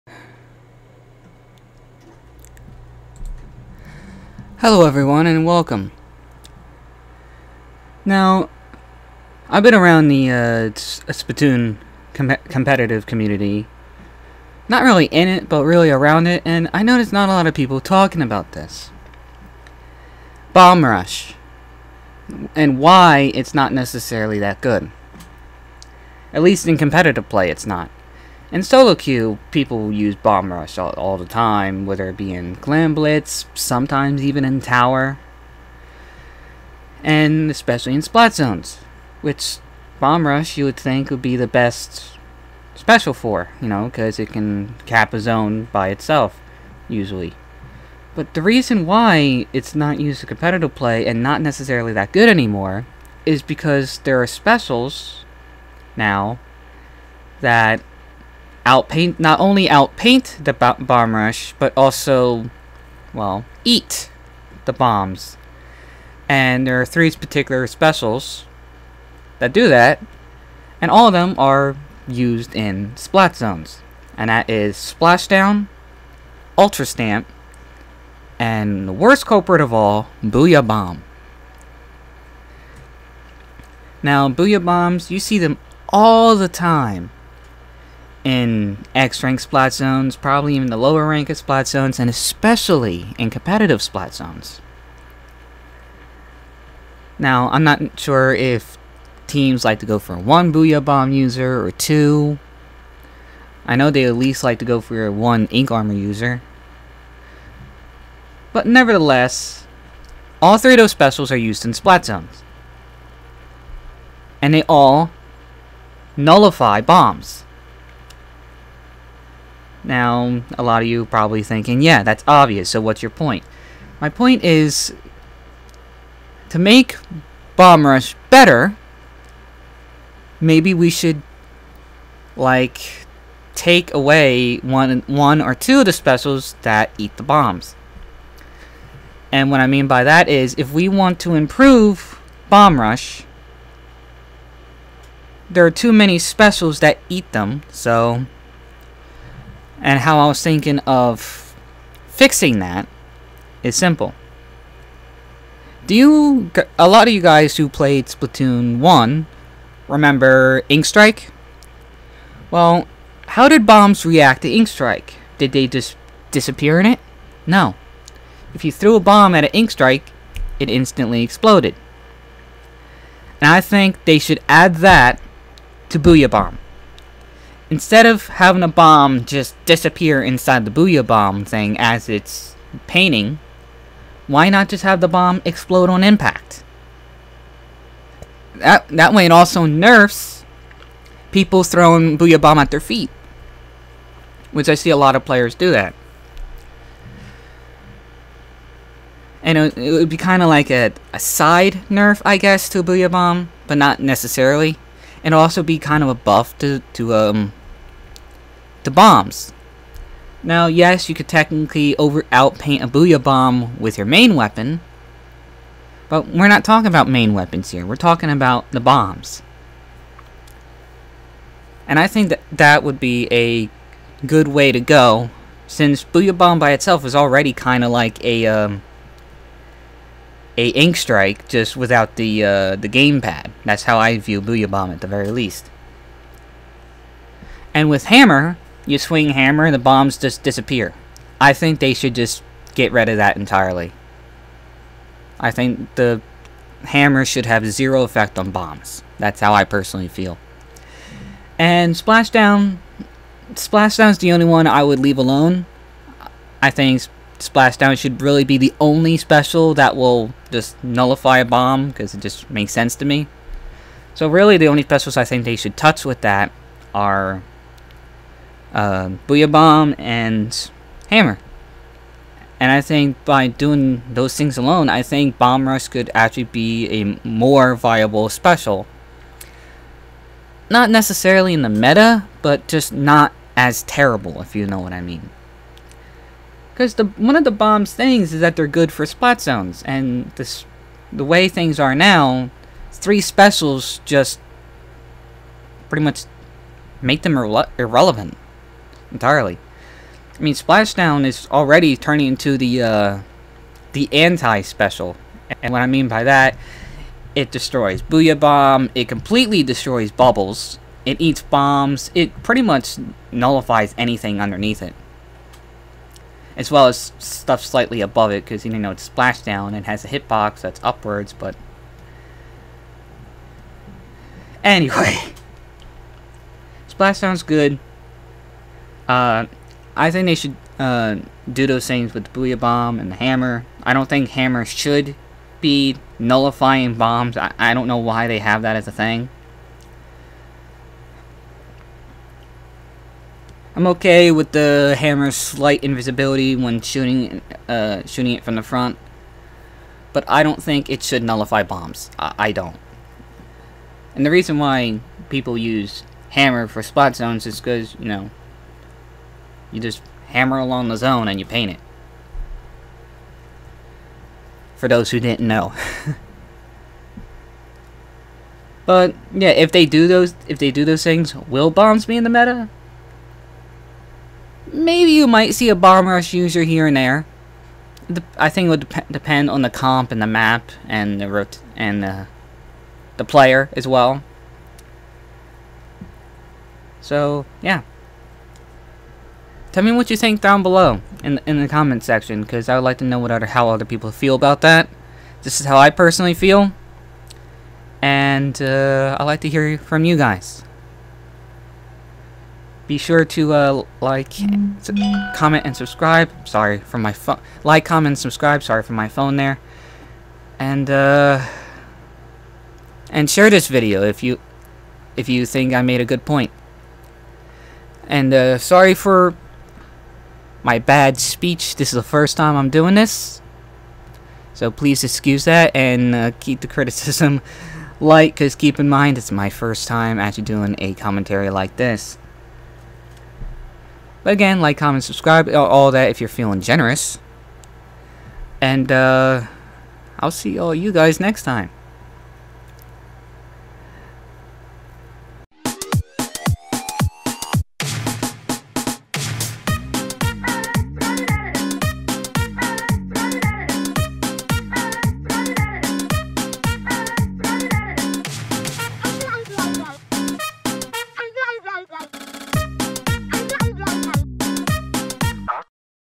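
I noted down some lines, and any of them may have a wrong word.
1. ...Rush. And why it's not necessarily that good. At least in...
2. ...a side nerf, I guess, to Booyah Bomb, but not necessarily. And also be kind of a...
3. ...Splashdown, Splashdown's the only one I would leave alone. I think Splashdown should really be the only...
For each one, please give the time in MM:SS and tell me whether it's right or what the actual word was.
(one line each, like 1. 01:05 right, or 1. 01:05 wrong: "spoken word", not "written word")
1. 00:20 right
2. 03:21 right
3. 04:11 right.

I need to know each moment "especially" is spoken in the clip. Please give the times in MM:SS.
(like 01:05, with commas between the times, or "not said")
00:37, 01:32.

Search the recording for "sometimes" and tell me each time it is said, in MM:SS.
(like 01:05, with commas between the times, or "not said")
00:33.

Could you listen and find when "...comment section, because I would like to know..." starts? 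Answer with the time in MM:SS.
06:31.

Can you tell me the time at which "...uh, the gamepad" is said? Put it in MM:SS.
03:52.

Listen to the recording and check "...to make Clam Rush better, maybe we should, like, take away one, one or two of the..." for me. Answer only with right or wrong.
wrong.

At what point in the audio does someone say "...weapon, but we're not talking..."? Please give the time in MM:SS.
03:34.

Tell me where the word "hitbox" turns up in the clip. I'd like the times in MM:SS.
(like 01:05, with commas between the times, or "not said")
05:20.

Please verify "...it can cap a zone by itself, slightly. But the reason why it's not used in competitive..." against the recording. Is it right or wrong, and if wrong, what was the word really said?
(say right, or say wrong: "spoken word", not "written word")
wrong: "usually", not "slightly".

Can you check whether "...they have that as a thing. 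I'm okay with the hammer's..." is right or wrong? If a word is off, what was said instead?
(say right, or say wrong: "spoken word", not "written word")
right.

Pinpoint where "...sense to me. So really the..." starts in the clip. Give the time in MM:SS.
04:22.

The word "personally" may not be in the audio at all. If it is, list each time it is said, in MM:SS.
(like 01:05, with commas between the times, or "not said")
04:09, 06:35.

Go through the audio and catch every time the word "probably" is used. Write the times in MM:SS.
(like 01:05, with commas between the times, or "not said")
01:30, 02:01.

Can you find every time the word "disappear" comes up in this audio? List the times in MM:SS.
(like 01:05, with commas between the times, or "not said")
02:46, 02:59, 04:00.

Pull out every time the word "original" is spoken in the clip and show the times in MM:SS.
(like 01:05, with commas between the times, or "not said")
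not said.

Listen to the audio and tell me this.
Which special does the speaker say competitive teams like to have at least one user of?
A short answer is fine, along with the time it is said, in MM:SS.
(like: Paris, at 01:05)
Ink Armor, at 01:45.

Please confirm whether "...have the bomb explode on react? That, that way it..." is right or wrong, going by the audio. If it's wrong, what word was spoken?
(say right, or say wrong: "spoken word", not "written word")
wrong: "impact", not "react".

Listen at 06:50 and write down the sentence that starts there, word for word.
And uh, and share this video if you if you think I made a good point.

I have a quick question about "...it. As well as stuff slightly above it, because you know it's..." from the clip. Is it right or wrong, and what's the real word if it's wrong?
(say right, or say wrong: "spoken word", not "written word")
right.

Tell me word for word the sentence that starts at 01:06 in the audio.
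And there are three particular specials that do that, and all of them are used in splat zones.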